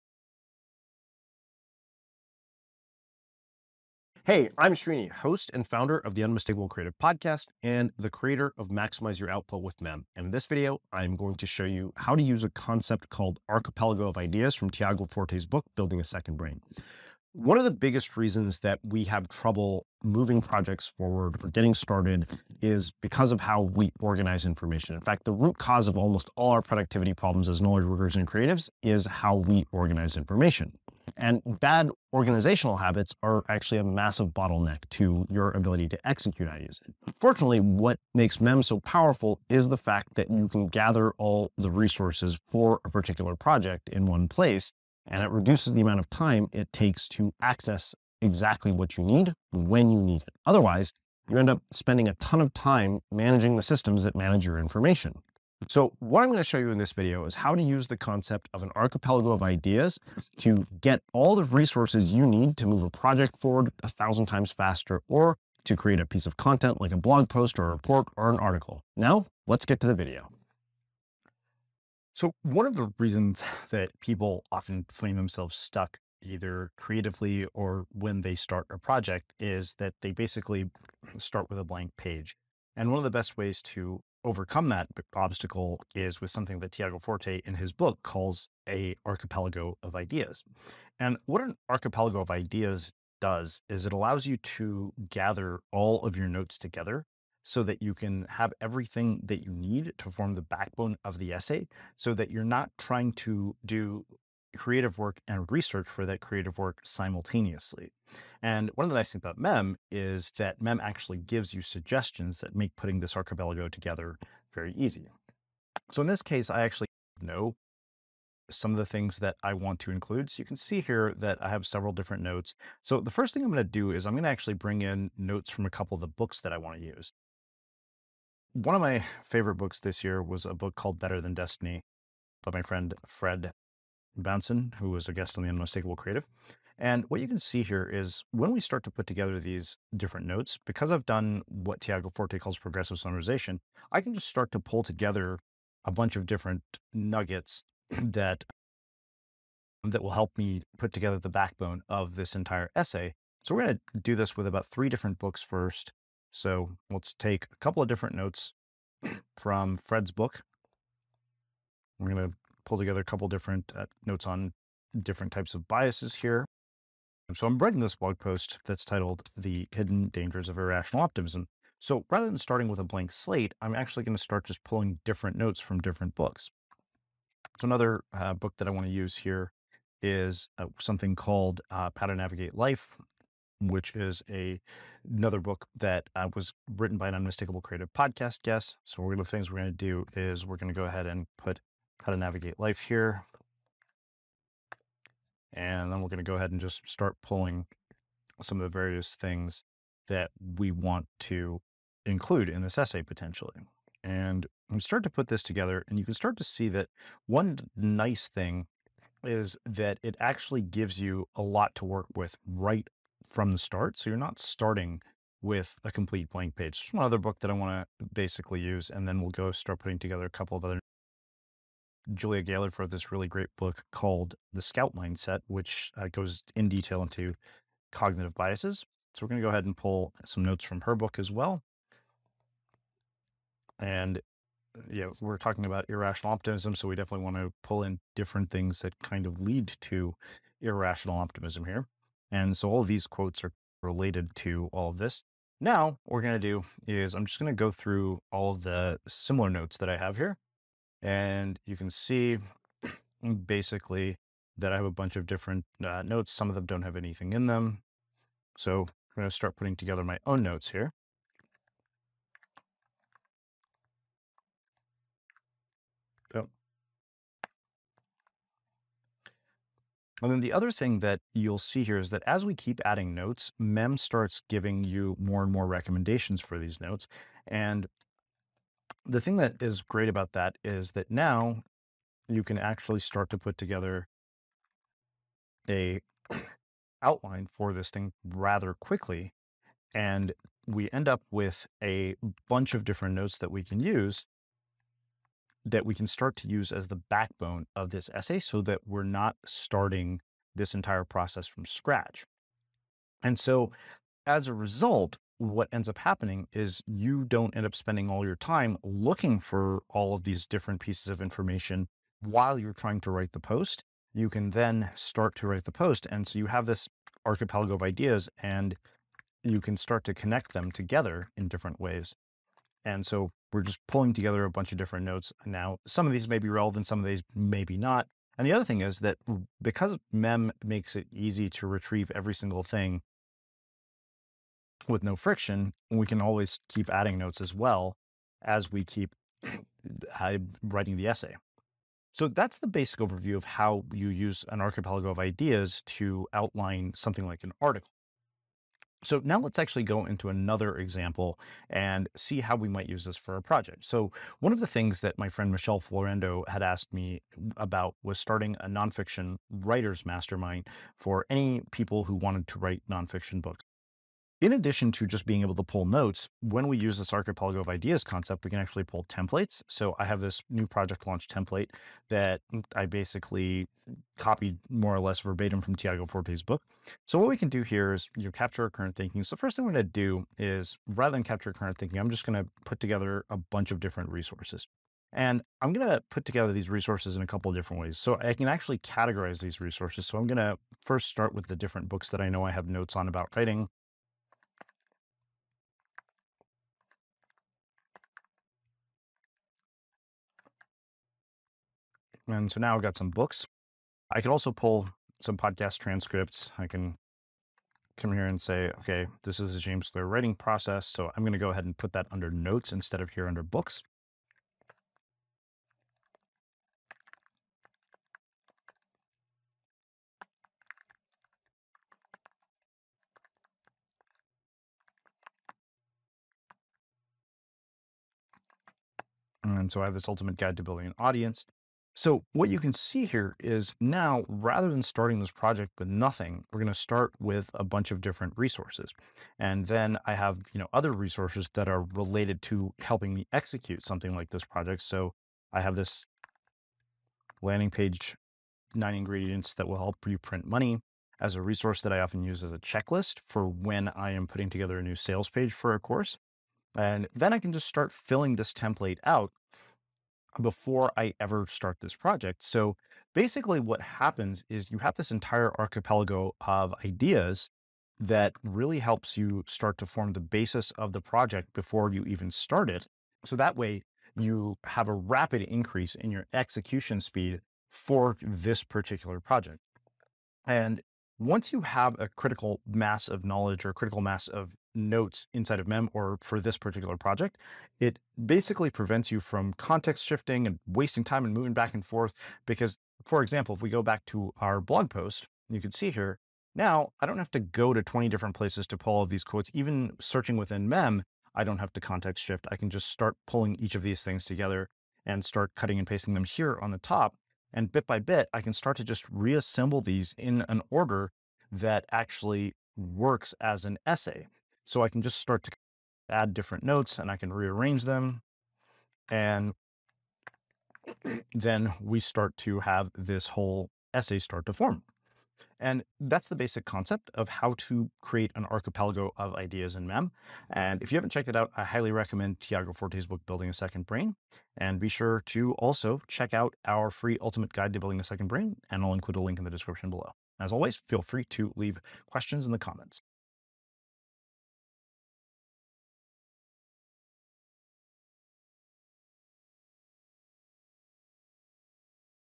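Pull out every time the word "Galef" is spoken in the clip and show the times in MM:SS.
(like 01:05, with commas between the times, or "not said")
03:42.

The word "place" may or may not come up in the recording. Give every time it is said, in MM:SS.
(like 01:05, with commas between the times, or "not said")
00:44, 08:18.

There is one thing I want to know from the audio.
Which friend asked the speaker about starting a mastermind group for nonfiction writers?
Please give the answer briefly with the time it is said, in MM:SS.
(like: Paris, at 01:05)
Michelle Florendo, at 05:55.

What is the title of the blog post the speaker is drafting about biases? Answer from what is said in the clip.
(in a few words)
The Hidden Dangers of Irrational Optimism.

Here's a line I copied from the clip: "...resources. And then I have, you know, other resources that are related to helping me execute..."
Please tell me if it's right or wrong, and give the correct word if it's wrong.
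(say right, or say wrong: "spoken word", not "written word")
right.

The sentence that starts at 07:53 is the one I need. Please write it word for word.
So that way, you have a rapid increase in your execution speed for this particular project.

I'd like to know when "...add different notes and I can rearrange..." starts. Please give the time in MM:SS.
08:36.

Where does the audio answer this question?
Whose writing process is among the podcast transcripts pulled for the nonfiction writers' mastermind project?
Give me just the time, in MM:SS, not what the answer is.
06:49.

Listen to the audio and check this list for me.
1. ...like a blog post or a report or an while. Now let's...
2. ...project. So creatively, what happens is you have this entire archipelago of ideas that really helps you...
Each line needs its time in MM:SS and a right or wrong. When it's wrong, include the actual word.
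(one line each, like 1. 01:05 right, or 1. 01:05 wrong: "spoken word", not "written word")
1. 01:06 wrong: "article", not "while"
2. 07:41 wrong: "basically", not "creatively".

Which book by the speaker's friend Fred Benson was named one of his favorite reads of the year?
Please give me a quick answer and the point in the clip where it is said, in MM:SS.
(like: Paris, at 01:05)
Better Than Destiny, at 02:10.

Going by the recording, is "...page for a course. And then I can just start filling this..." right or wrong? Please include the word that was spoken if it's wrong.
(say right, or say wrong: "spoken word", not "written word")
right.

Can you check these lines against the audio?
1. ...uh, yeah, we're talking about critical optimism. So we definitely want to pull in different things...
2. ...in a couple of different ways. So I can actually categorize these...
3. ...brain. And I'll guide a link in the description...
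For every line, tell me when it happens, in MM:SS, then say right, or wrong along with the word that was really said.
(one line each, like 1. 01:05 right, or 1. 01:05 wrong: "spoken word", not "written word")
1. 03:54 wrong: "irrational", not "critical"
2. 06:27 right
3. 08:58 wrong: "include", not "guide".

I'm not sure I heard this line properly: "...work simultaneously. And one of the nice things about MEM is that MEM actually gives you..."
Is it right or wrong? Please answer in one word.
right.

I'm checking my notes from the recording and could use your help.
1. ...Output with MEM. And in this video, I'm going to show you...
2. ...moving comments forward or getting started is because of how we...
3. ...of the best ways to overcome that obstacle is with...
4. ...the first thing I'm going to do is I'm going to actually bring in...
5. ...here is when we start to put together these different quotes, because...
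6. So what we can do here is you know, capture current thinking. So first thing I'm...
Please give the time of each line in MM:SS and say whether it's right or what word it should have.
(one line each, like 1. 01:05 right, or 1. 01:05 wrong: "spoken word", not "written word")
1. 00:09 right
2. 00:20 wrong: "projects", not "comments"
3. 01:22 right
4. 02:02 right
5. 02:17 wrong: "notes", not "quotes"
6. 06:17 right.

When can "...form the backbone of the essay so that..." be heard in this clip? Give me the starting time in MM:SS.
01:40.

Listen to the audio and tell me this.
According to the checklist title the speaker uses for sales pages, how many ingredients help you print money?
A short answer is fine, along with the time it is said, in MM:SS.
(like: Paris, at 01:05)
9, at 07:28.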